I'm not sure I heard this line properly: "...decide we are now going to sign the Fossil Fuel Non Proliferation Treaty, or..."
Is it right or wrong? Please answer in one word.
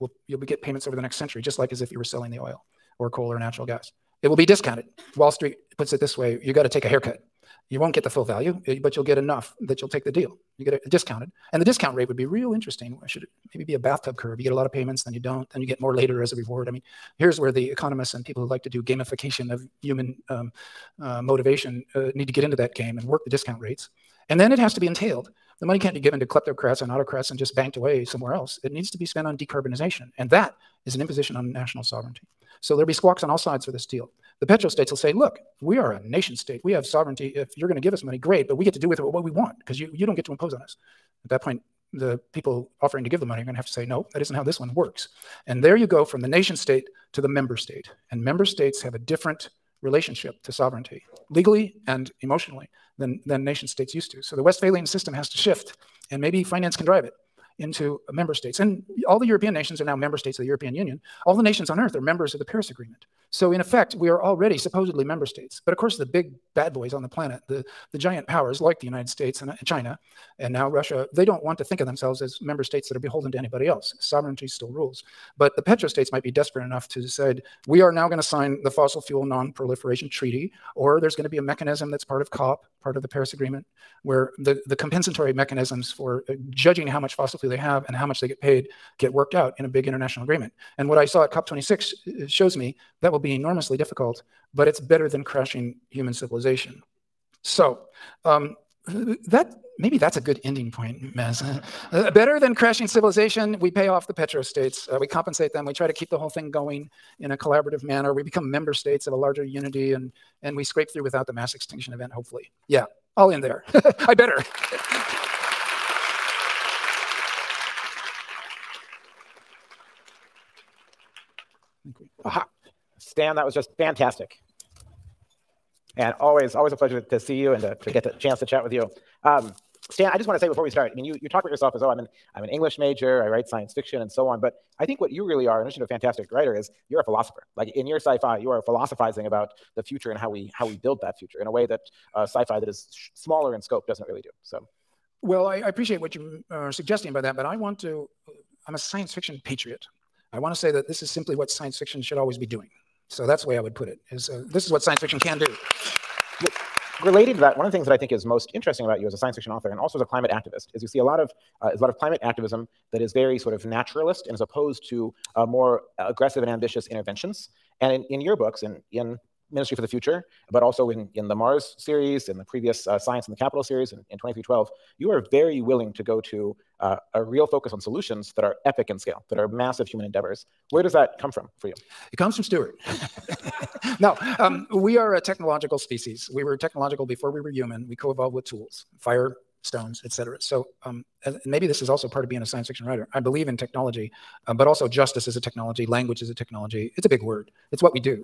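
right.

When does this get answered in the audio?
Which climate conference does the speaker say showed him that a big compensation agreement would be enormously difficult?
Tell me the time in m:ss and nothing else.
1:31.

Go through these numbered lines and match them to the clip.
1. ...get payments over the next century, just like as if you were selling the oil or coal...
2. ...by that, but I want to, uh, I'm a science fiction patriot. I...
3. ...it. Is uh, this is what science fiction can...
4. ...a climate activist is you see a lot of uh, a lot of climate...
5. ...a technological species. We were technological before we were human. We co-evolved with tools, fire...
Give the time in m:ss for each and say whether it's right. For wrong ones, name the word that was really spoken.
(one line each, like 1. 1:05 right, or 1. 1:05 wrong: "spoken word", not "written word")
1. 0:00 right
2. 2:27 right
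3. 2:33 right
4. 2:40 right
5. 3:05 right.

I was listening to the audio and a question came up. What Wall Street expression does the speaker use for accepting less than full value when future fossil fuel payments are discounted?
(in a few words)
take a haircut.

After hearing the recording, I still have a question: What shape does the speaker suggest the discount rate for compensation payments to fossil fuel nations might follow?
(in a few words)
bathtub curve.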